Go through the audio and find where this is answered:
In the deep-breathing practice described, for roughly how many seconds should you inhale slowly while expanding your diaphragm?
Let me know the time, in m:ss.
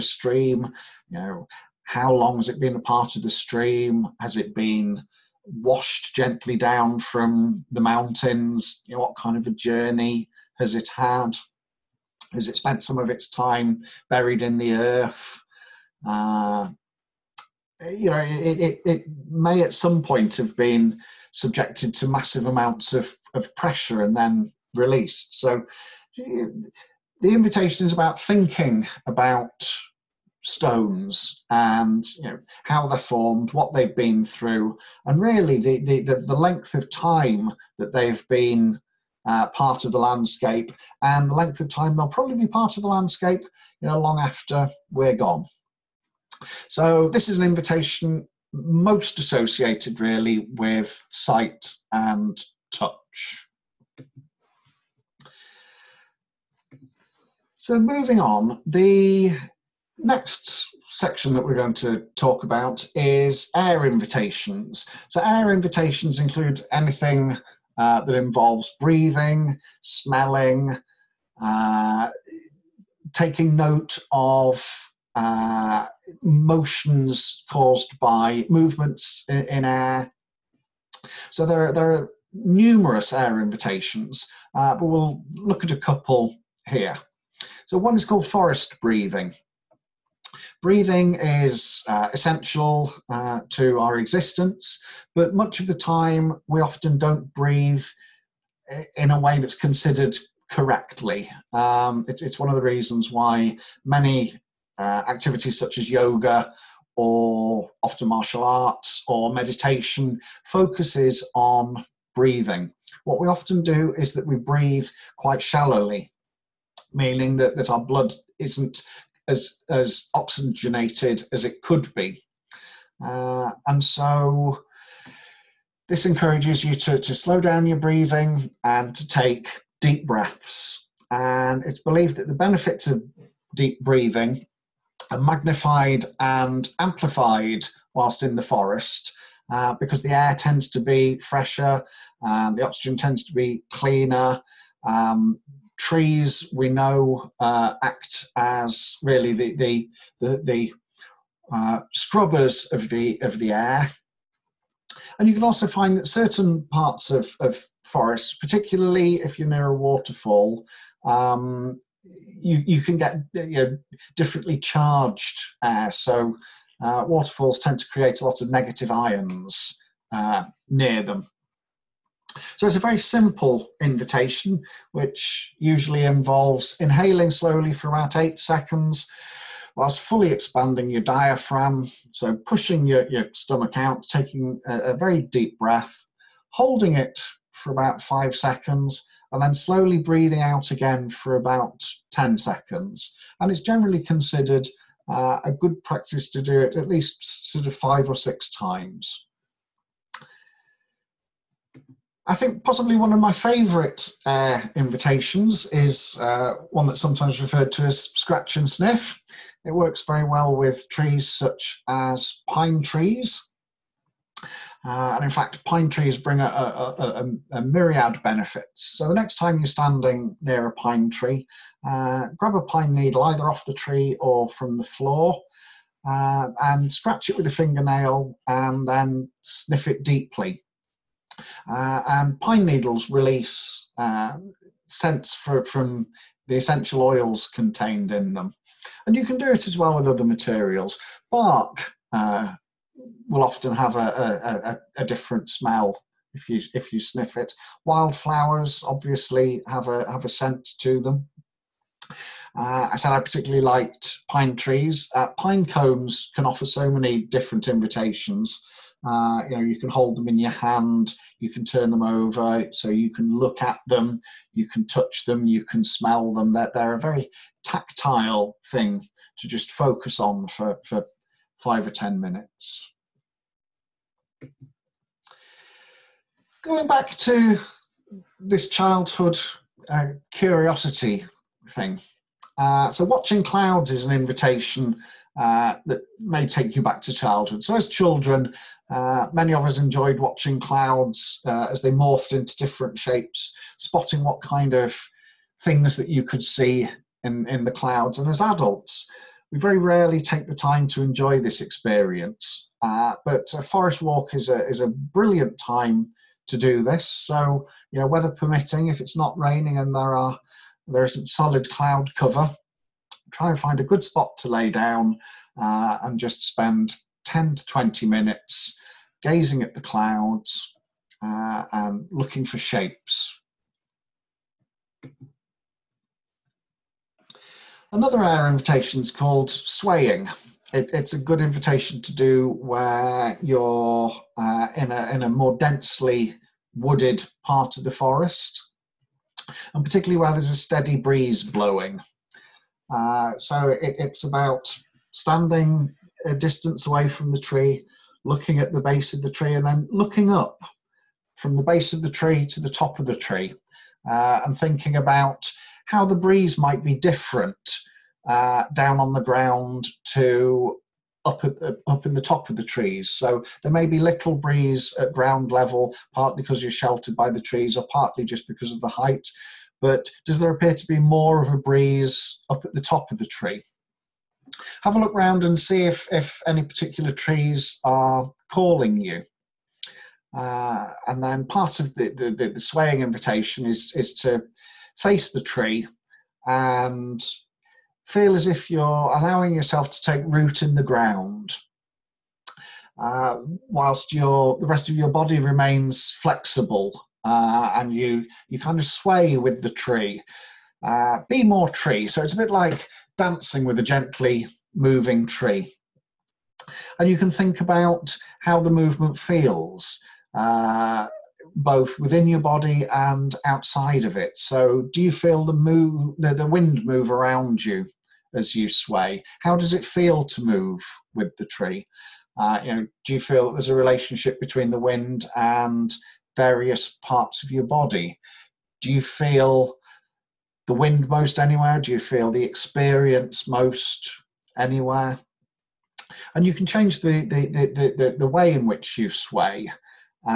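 2:58.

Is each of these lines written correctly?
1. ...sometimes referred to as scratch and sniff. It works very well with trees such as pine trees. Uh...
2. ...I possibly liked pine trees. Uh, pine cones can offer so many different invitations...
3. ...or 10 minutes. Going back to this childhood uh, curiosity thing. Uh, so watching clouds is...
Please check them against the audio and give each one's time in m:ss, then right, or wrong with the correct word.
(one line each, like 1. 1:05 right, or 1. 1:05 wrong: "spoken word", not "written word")
1. 3:27 right
2. 4:13 wrong: "particularly", not "possibly"
3. 4:31 right.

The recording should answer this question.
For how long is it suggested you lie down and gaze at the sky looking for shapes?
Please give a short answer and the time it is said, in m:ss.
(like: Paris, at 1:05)
10 to 20 minutes, at 5:17.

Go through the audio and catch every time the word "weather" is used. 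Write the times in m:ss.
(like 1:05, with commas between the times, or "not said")
5:08.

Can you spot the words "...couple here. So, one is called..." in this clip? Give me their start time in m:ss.
1:25.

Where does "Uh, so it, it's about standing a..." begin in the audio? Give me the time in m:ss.
5:42.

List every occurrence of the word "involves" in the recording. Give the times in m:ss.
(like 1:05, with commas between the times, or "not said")
1:08, 2:56.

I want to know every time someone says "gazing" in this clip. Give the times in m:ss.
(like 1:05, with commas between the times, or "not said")
5:19.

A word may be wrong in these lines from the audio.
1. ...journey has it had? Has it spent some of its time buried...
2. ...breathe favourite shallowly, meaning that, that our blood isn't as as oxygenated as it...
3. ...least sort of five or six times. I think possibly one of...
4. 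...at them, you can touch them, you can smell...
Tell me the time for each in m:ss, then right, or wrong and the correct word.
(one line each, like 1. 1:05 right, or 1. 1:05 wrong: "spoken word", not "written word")
1. 0:09 right
2. 1:54 wrong: "quite", not "favourite"
3. 3:16 right
4. 4:23 right.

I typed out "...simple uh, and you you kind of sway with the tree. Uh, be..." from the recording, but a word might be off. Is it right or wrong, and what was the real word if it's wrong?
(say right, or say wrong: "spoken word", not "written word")
wrong: "flexible", not "simple".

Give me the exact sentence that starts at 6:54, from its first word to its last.
So, do you feel the, move, the, the wind move around you as you sway?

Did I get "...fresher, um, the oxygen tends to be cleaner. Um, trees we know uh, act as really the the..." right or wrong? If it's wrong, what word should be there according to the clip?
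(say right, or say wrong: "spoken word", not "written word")
right.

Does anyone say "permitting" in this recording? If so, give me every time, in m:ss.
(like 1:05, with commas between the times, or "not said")
5:08.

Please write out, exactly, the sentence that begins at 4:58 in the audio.
And as adults, we very rarely take the time to enjoy this experience.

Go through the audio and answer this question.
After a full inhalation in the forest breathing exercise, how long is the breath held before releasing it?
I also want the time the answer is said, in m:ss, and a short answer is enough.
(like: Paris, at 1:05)
5 seconds, at 3:08.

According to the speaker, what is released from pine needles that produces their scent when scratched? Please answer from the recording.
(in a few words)
essential oils.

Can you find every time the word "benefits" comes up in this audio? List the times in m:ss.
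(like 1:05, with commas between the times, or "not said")
2:12, 3:38.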